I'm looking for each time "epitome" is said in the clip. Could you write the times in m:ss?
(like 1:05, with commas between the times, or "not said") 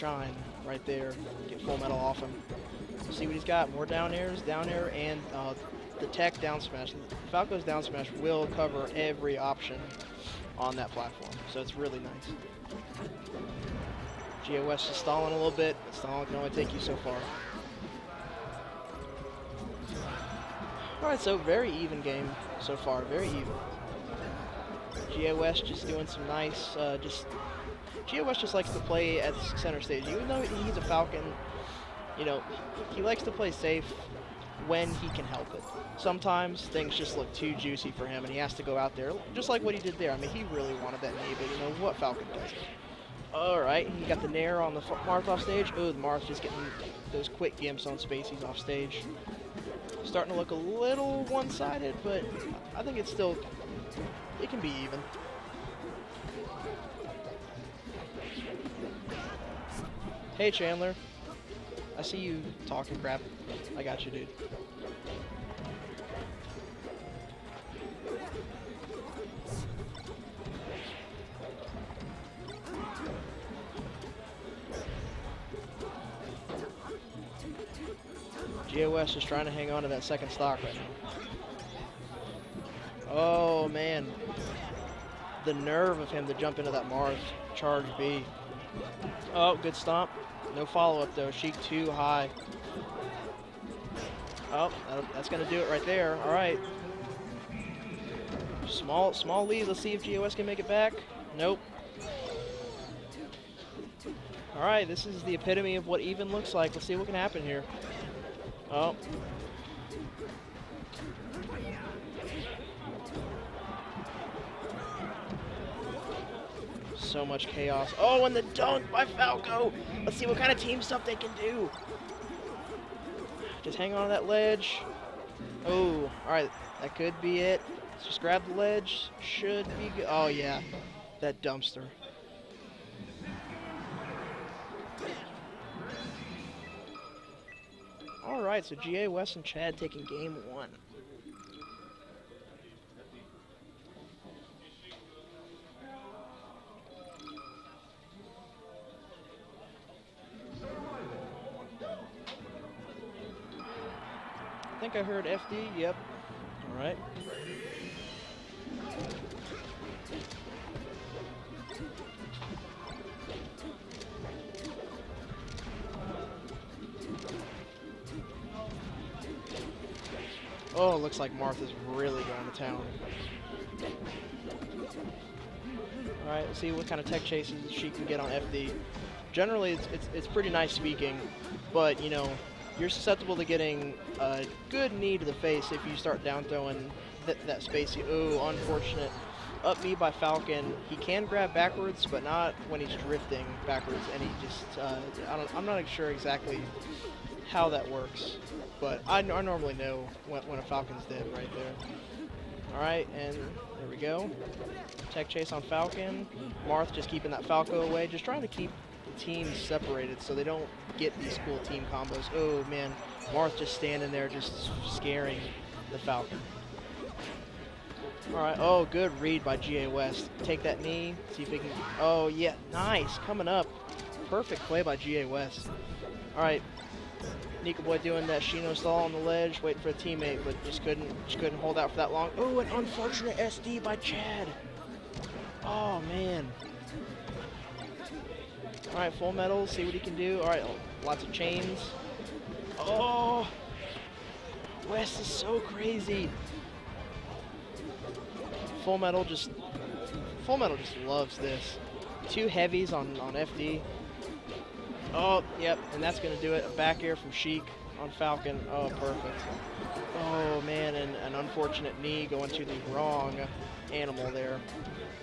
1:45.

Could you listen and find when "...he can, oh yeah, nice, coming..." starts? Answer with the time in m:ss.
3:41.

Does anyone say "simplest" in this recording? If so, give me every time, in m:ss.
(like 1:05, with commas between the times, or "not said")
not said.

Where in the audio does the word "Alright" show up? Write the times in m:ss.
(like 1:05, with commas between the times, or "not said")
0:21, 2:56, 3:22.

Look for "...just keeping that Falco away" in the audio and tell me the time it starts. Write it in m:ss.
3:26.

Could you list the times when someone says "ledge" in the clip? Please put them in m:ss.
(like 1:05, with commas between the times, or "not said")
2:04, 2:08, 3:49.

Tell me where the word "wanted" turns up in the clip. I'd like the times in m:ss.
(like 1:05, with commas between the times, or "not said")
0:40.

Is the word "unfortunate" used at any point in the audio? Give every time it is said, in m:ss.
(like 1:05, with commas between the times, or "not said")
3:08, 3:52, 4:21.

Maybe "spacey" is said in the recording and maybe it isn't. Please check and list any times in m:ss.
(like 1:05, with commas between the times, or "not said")
0:47, 3:07.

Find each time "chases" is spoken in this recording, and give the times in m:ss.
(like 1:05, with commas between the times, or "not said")
2:57, 3:25.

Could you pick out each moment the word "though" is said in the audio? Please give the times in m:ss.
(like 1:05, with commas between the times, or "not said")
0:30, 1:31.